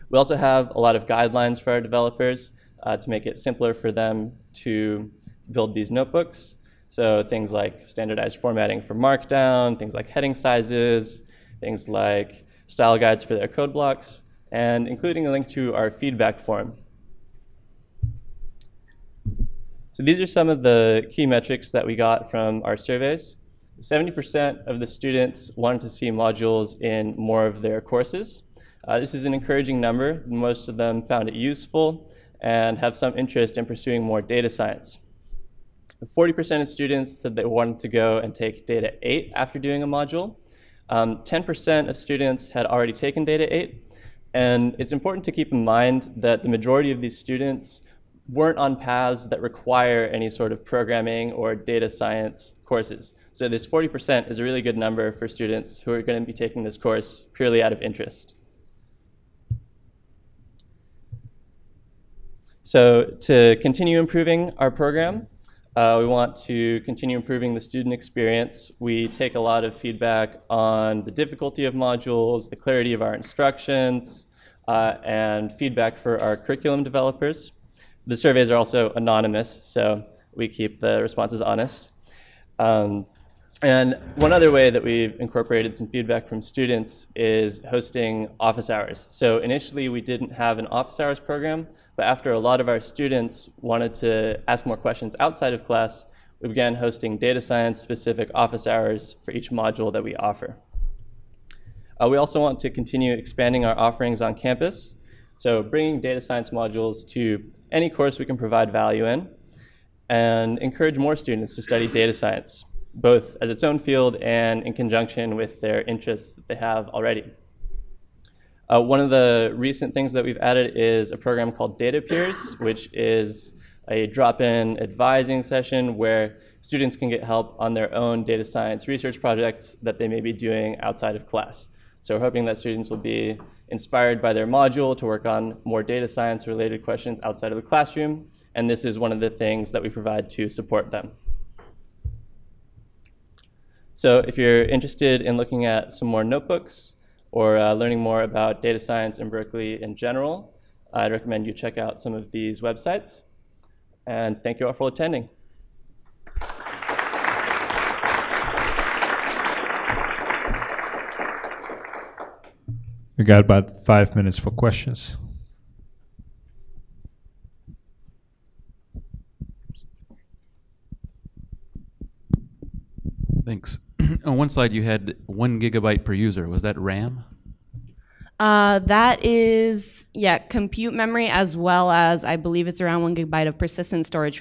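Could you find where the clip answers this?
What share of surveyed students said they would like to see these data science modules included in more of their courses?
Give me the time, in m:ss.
0:23.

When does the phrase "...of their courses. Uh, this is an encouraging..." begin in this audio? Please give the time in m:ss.
0:27.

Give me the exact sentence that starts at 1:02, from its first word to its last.
So to continue improving our program, uh, we want to continue improving the student experience.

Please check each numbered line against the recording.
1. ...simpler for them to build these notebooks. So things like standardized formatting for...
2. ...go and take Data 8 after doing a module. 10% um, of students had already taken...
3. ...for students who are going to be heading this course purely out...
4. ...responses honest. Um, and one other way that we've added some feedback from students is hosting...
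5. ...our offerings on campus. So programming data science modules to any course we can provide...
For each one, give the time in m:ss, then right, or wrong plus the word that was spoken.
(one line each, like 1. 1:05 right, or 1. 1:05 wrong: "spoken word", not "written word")
1. 0:03 right
2. 0:37 right
3. 0:55 wrong: "taking", not "heading"
4. 1:21 wrong: "incorporated", not "added"
5. 1:43 wrong: "bringing", not "programming".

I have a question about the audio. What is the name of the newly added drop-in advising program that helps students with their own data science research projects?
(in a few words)
Data Peers.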